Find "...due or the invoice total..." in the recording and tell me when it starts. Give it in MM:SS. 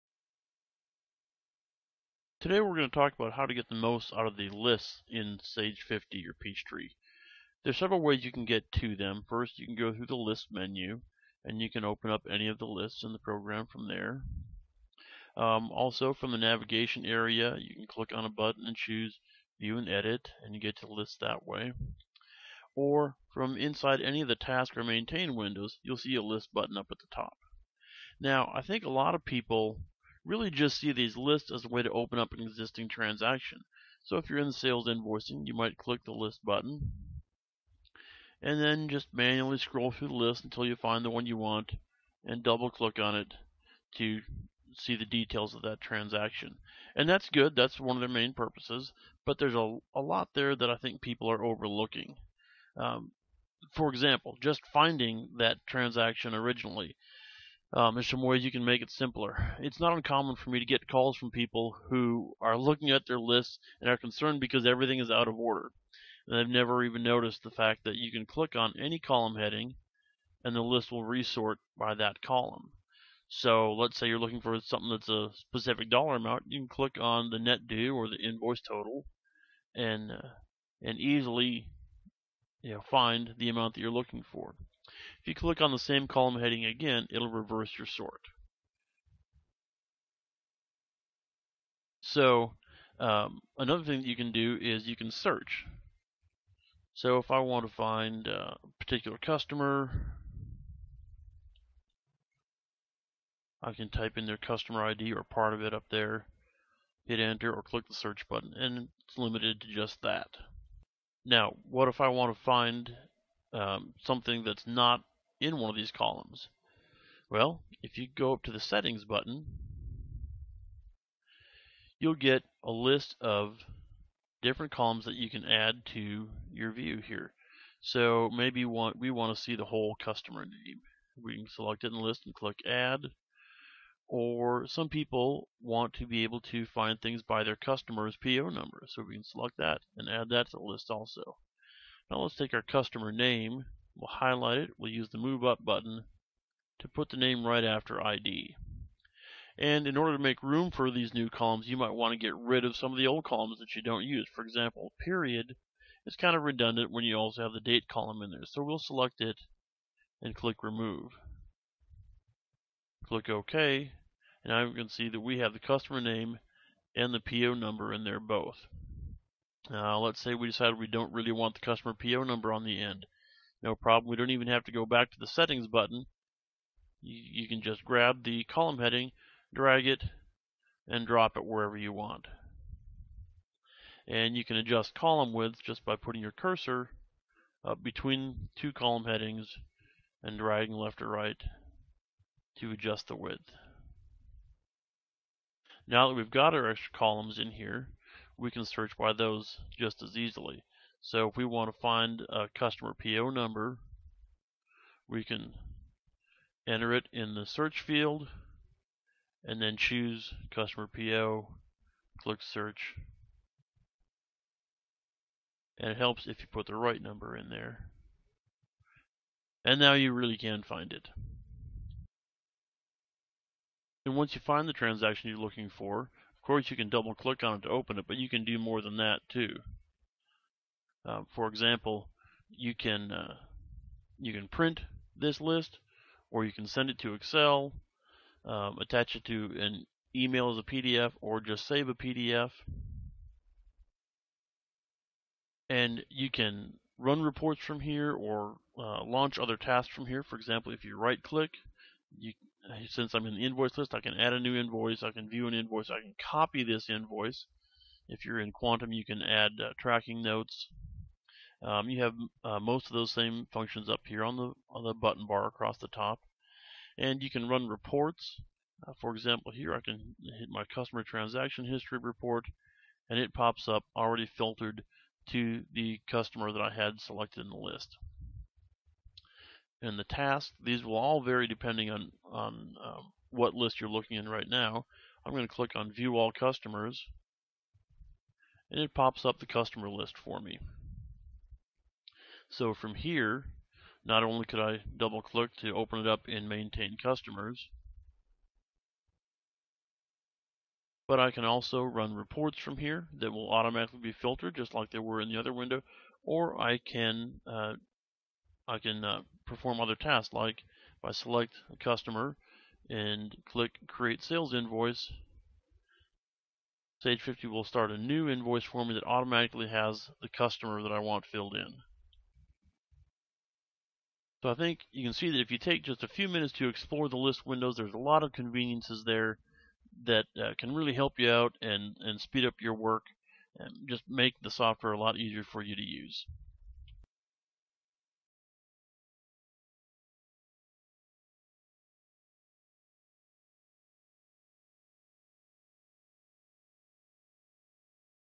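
01:17.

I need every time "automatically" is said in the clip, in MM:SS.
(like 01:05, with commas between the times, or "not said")
05:03, 05:19.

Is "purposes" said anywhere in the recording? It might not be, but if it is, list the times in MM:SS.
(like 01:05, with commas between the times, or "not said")
00:48.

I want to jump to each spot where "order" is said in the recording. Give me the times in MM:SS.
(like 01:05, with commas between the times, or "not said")
01:05, 02:29.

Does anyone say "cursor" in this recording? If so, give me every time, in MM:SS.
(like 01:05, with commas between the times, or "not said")
03:06.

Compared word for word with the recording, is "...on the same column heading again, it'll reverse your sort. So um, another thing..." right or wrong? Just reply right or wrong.
right.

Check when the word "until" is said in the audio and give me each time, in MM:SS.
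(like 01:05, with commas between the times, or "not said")
00:40.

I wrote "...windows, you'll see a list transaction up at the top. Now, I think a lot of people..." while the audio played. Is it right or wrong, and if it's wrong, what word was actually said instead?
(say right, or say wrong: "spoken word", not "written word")
wrong: "button", not "transaction".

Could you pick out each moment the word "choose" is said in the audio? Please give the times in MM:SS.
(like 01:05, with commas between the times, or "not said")
00:18, 03:29.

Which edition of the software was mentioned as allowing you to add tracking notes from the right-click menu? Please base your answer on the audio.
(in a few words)
Quantum.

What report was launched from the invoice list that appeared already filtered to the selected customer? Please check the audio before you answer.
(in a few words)
Customer transaction history.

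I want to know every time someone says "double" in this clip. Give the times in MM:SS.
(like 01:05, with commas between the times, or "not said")
00:42, 03:46, 04:54.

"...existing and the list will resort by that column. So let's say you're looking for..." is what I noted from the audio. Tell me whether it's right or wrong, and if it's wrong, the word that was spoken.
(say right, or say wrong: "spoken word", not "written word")
wrong: "heading", not "existing".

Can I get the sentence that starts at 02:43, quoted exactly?
Click OK, and now you can see that we have the customer name and the PO number in there both.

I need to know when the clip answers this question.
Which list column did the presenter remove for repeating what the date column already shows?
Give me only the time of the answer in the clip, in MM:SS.
02:34.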